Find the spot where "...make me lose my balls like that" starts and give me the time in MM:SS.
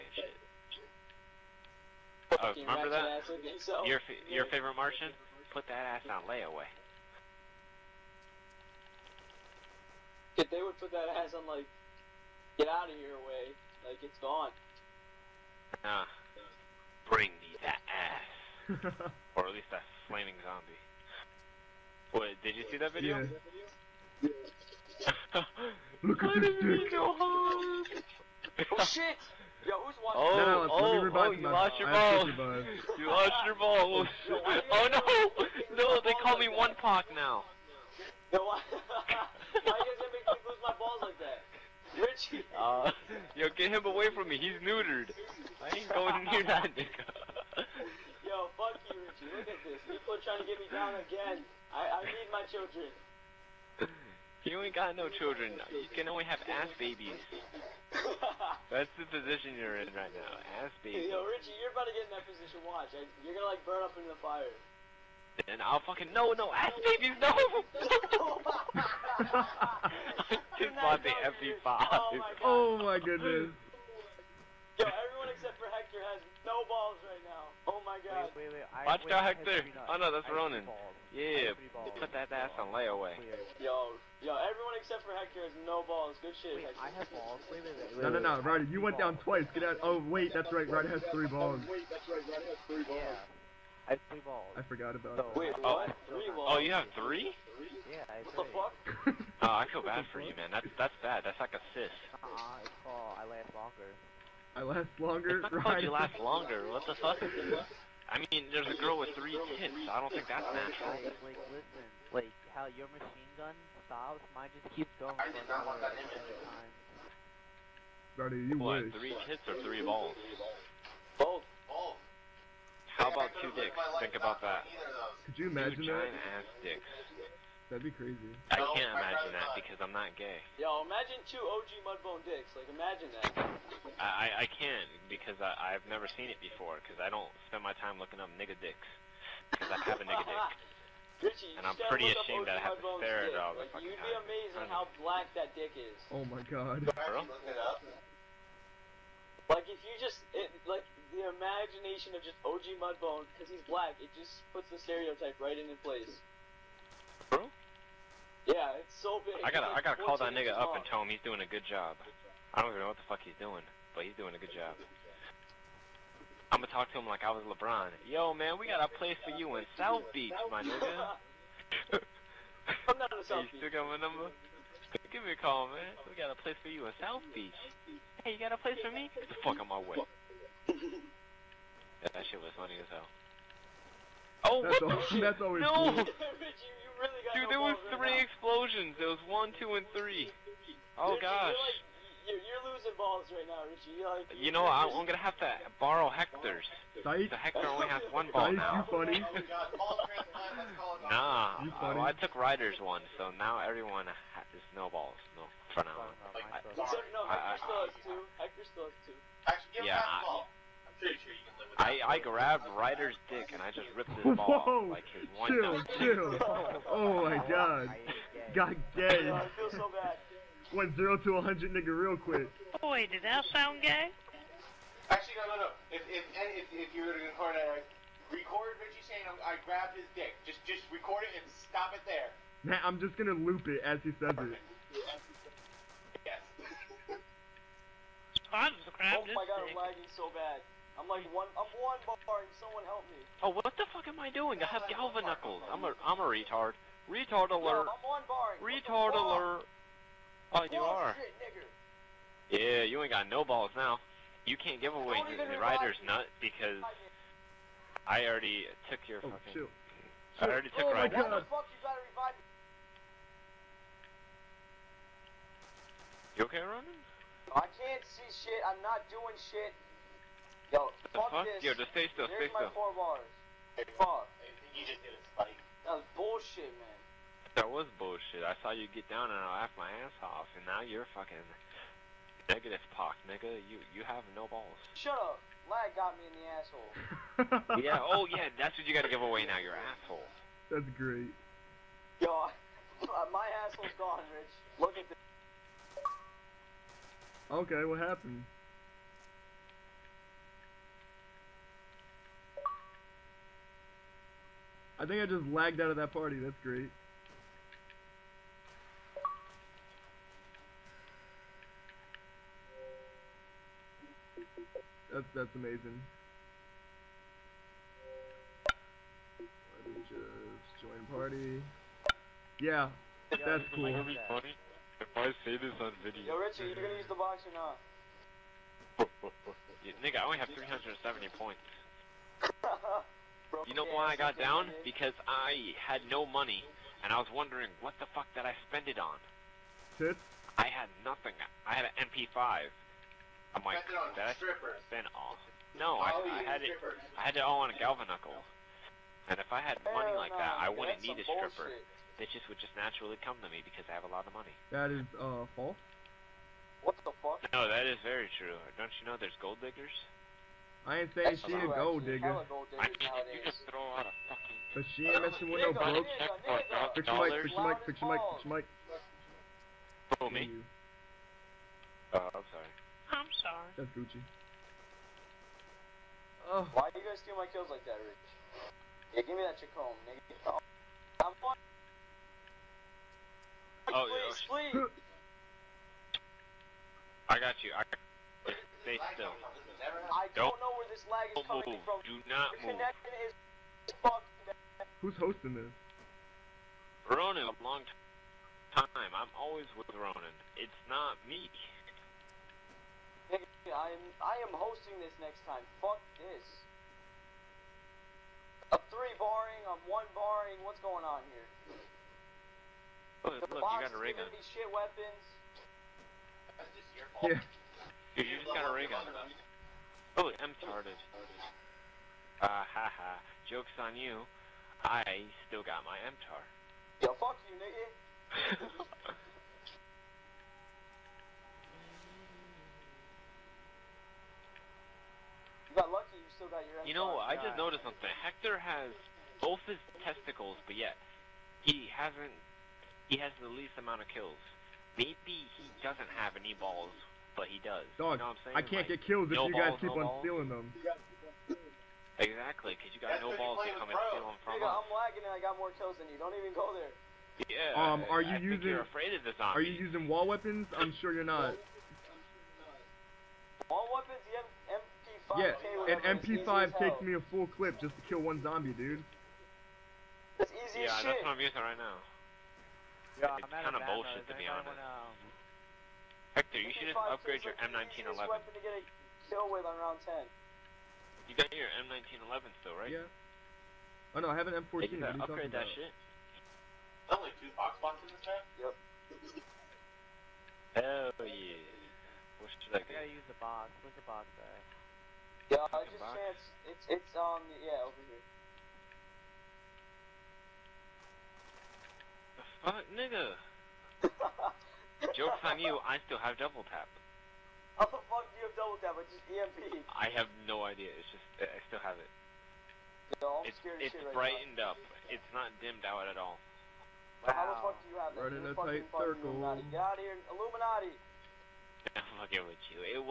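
00:39.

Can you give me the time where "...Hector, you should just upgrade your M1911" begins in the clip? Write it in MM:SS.
07:56.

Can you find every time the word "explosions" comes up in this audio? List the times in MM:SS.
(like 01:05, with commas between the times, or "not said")
03:08.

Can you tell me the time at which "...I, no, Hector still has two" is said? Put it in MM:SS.
03:26.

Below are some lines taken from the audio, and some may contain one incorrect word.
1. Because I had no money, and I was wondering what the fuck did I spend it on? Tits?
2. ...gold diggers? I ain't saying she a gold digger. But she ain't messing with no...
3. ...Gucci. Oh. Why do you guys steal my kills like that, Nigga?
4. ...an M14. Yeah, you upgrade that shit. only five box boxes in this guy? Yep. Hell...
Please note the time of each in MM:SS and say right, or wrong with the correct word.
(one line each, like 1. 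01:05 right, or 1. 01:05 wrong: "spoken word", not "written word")
1. 05:34 right
2. 05:59 right
3. 06:13 wrong: "Rich", not "Nigga"
4. 08:04 wrong: "two", not "five".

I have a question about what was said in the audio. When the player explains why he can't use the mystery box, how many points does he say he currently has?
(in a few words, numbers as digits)
370.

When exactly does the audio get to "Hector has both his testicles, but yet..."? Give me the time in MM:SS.
07:18.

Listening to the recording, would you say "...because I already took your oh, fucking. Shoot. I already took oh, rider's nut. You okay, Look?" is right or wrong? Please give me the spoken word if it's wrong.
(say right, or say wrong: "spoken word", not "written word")
wrong: "Ronan", not "Look".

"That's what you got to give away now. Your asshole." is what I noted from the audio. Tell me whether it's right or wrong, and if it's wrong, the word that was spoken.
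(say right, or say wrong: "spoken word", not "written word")
right.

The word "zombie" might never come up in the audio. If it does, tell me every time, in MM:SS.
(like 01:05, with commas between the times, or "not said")
00:20, 07:39, 07:48.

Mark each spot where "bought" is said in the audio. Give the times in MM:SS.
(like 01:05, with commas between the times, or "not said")
01:10.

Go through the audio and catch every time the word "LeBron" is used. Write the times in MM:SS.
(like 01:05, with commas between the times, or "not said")
02:47.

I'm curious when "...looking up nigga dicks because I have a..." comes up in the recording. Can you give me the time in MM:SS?
02:18.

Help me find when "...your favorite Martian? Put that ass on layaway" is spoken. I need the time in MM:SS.
00:04.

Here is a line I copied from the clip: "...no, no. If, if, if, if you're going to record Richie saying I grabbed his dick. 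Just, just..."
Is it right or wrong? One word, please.
right.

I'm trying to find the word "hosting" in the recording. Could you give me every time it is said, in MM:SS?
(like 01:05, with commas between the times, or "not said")
06:35, 06:44.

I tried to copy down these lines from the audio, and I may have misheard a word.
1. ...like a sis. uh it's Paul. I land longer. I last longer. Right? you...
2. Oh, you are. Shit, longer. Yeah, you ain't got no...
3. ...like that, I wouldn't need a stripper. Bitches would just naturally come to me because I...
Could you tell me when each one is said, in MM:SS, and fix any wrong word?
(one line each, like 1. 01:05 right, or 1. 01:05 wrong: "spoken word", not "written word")
1. 01:41 right
2. 04:10 wrong: "nigger", not "longer"
3. 05:50 right.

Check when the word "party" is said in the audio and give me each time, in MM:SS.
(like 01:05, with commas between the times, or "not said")
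05:06, 05:21.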